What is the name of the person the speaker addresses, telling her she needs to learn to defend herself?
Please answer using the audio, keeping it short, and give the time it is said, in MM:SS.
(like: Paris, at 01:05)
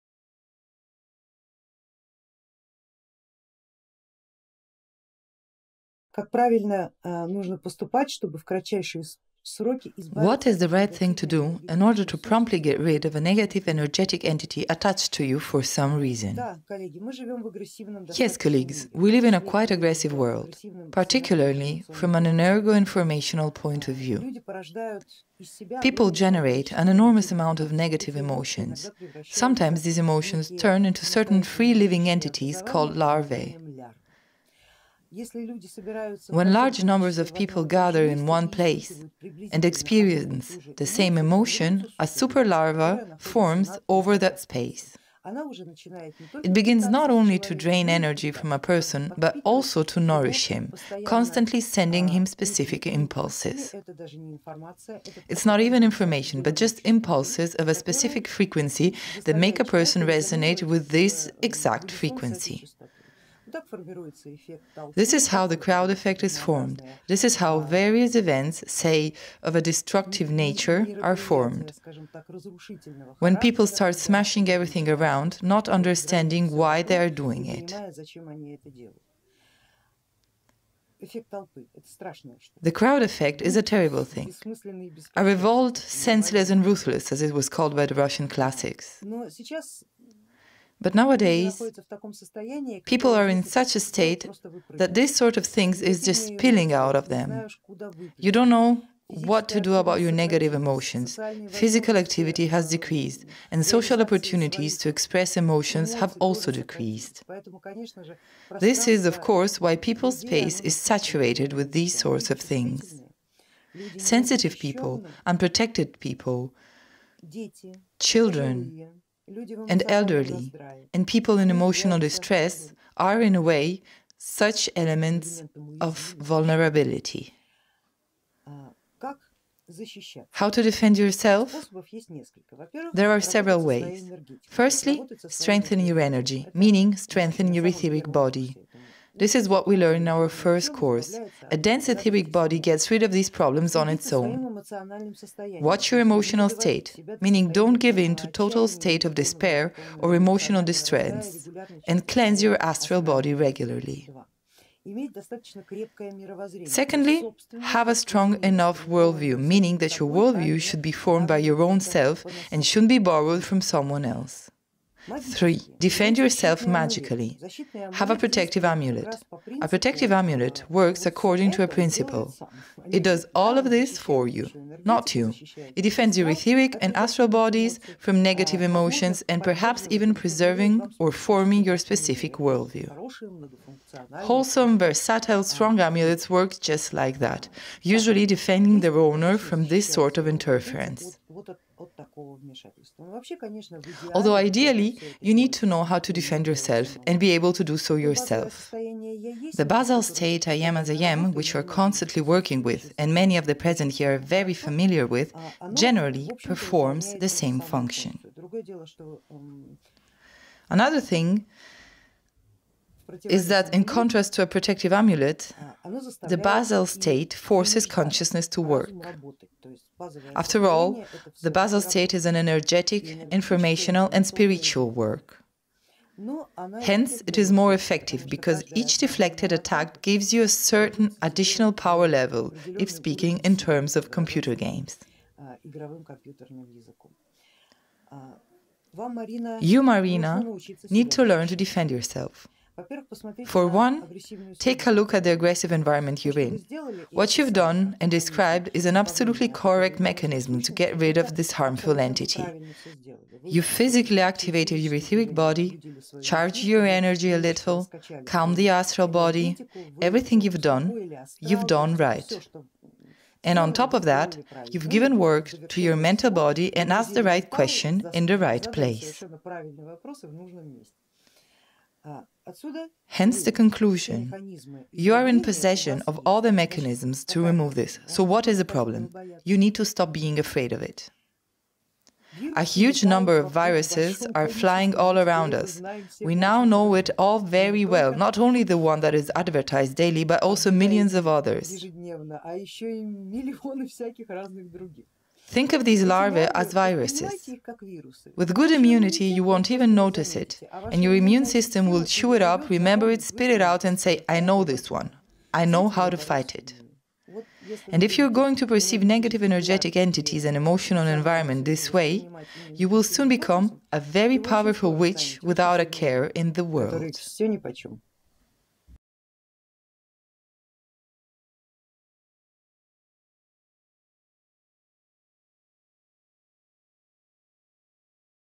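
Marina, at 03:59.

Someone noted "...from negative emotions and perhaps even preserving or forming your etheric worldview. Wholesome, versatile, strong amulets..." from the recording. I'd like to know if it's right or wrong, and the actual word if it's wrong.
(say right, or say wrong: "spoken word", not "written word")
wrong: "specific", not "etheric".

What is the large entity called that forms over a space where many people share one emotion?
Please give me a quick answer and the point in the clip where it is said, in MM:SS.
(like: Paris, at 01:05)
superlarva, at 00:42.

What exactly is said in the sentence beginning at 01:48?
This is, of course, why people's space is saturated with these sorts of things.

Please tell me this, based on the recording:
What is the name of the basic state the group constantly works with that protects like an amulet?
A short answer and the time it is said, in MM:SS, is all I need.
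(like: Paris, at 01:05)
I am as I am, at 03:20.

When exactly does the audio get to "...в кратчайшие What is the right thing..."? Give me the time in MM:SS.
00:08.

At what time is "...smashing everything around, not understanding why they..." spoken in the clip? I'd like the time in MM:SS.
01:13.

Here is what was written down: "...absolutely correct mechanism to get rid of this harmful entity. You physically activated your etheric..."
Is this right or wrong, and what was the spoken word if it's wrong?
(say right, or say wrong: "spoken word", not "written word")
right.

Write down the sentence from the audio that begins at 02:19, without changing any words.
This is what we learn in our first course.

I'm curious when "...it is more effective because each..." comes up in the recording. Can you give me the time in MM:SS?
03:47.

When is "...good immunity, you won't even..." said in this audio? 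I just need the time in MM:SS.
04:58.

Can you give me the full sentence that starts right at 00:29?
Sometimes these emotions turn into certain free living entities called larvae.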